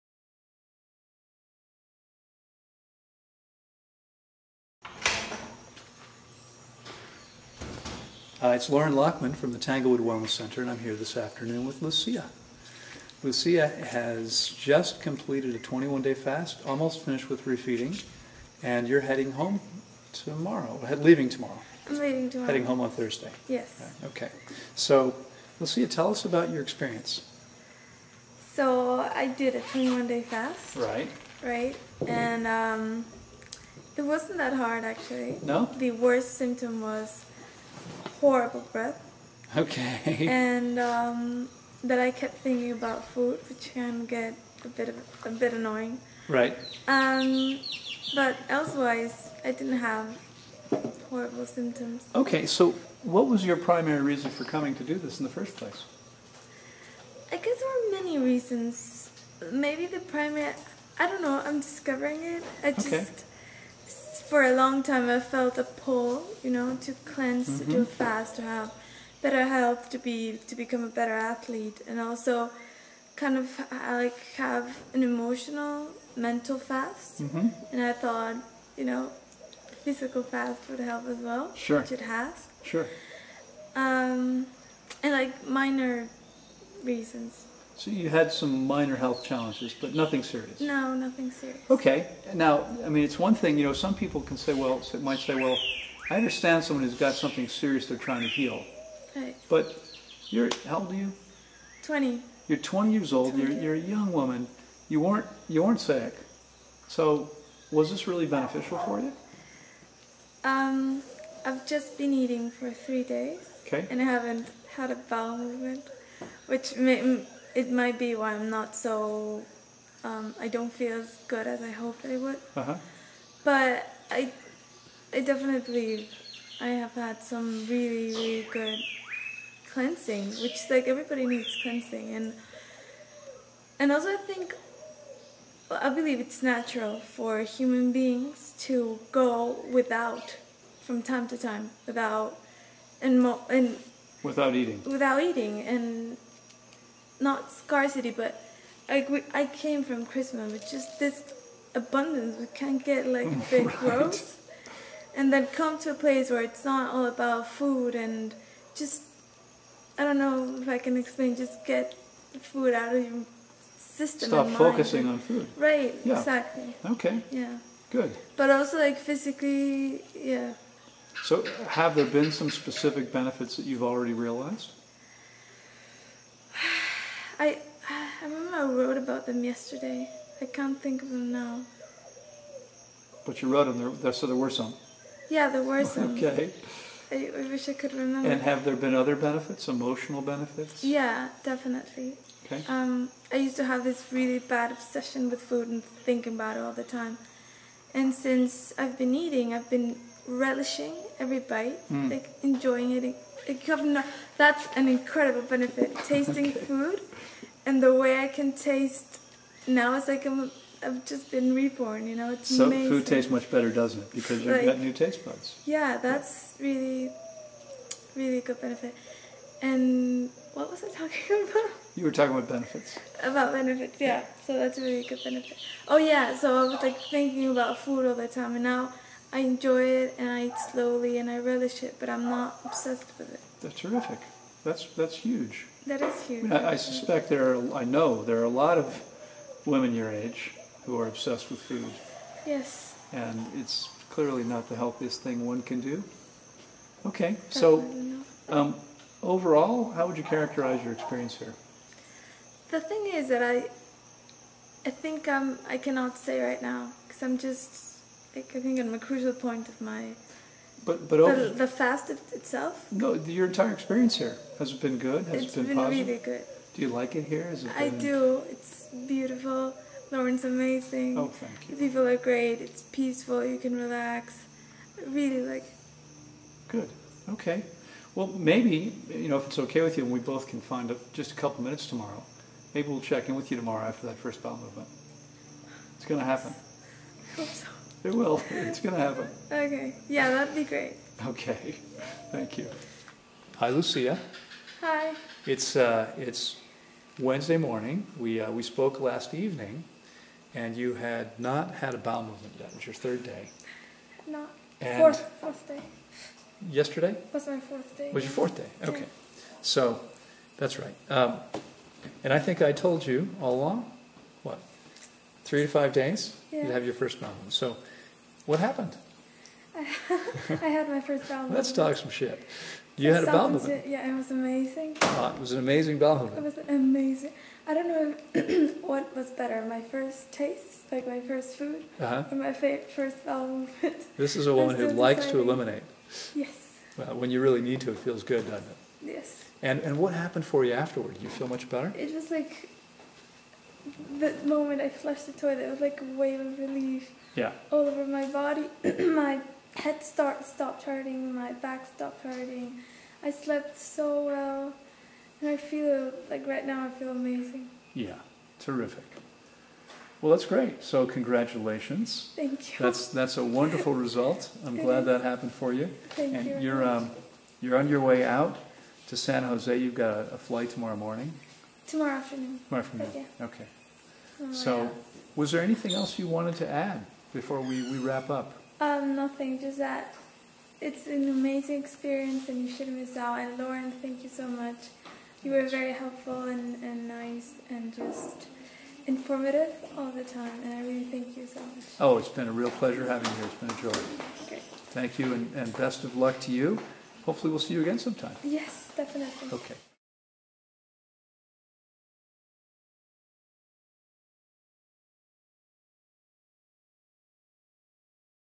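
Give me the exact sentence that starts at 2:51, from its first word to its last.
So, have there been some specific benefits that you've already realized?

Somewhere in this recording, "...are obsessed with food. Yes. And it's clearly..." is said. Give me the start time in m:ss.
4:00.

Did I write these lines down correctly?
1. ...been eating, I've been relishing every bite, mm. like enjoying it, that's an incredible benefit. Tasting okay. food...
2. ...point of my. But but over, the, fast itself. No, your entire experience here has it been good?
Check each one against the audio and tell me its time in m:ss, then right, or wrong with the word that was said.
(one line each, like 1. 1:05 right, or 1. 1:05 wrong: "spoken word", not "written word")
1. 3:18 right
2. 4:19 right.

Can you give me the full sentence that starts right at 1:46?
So, was this really beneficial for you?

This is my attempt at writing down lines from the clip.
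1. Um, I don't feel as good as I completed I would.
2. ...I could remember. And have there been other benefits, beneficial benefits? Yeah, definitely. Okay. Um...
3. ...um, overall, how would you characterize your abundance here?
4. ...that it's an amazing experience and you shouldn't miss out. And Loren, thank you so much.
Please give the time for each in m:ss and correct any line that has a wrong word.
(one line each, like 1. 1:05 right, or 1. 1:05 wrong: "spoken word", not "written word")
1. 2:00 wrong: "hoped", not "completed"
2. 3:07 wrong: "emotional", not "beneficial"
3. 4:08 wrong: "experience", not "abundance"
4. 6:19 right.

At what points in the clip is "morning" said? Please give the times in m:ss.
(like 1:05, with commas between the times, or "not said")
4:57, 6:10.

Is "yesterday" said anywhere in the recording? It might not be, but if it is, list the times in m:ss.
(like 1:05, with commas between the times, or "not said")
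2:59, 5:06.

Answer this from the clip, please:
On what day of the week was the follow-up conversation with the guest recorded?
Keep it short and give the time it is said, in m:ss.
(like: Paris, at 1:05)
Wednesday, at 4:57.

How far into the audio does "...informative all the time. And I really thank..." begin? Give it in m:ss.
6:29.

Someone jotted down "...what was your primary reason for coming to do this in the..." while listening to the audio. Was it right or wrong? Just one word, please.
right.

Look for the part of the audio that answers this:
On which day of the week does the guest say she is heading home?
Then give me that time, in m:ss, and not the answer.
0:22.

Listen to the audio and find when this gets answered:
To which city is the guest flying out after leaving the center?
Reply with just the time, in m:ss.
6:09.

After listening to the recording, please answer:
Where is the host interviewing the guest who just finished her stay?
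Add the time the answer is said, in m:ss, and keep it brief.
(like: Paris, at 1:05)
Tanglewood Wellness Center, at 0:09.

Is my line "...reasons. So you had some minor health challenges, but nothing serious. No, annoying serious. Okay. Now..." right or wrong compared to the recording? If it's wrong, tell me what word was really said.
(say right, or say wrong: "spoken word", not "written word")
wrong: "nothing", not "annoying".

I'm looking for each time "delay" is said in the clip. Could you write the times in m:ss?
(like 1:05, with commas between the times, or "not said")
not said.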